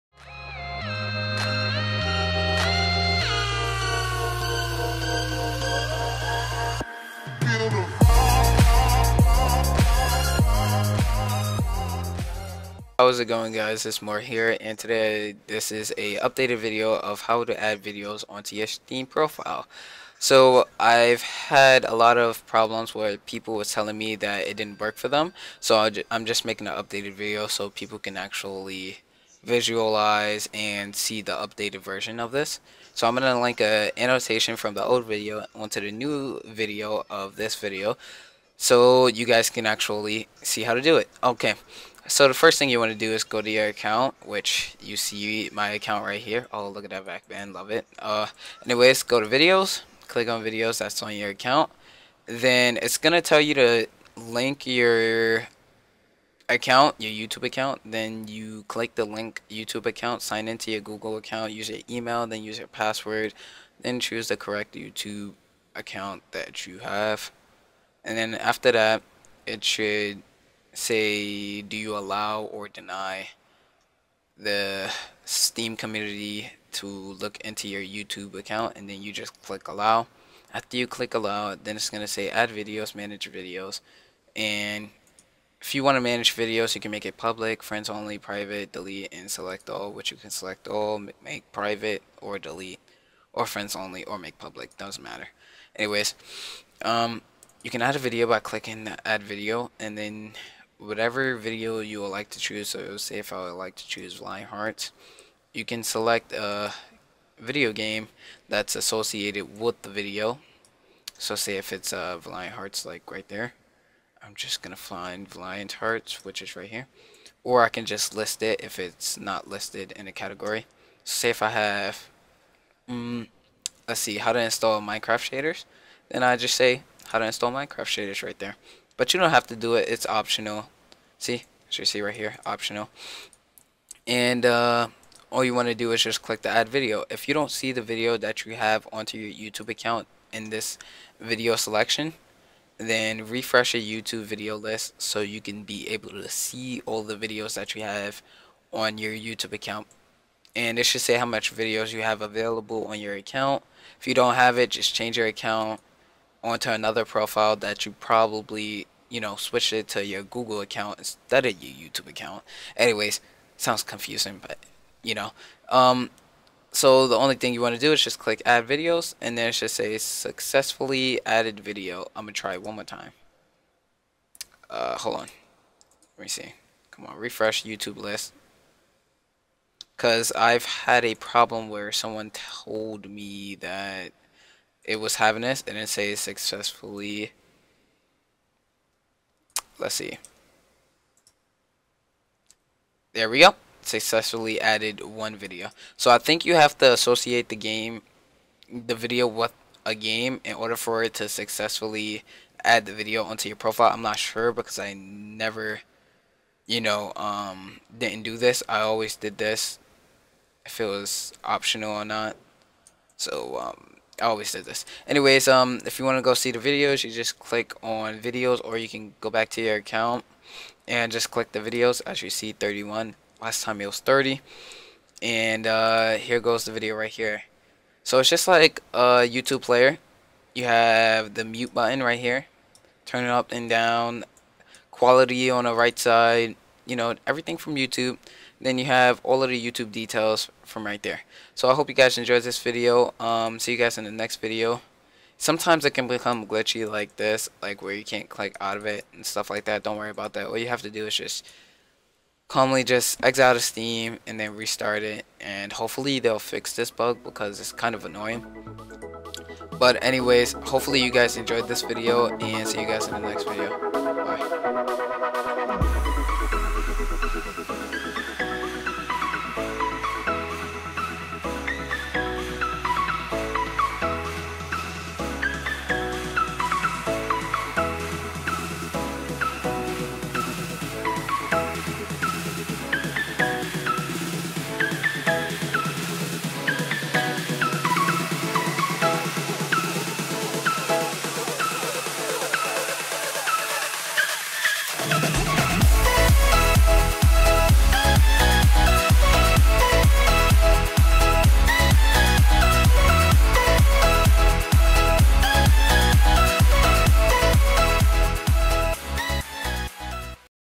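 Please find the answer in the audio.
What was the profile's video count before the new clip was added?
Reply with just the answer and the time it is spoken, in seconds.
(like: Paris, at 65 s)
30, at 223 s.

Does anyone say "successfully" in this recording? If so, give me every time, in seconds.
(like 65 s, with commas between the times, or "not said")
169 s, 186 s, 193 s, 201 s.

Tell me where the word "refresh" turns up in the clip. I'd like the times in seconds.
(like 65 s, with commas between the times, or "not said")
143 s, 177 s.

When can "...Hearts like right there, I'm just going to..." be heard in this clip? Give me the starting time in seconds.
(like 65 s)
112 s.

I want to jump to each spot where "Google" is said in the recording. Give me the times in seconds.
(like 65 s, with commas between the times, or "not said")
60 s, 160 s.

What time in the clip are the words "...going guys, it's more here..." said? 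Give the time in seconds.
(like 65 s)
13 s.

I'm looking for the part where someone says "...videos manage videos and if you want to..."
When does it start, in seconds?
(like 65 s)
82 s.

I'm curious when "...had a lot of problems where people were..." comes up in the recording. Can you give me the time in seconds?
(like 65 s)
21 s.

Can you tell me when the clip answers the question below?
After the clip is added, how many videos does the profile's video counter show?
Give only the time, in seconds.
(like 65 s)
222 s.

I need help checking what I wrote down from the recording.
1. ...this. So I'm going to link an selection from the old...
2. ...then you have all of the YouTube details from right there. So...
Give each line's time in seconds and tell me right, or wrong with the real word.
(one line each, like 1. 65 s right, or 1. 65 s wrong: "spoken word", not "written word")
1. 32 s wrong: "annotation", not "selection"
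2. 238 s right.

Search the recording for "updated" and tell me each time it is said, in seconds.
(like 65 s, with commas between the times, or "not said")
16 s, 26 s, 31 s.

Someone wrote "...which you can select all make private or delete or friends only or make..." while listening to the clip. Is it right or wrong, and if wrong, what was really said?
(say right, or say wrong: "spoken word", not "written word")
right.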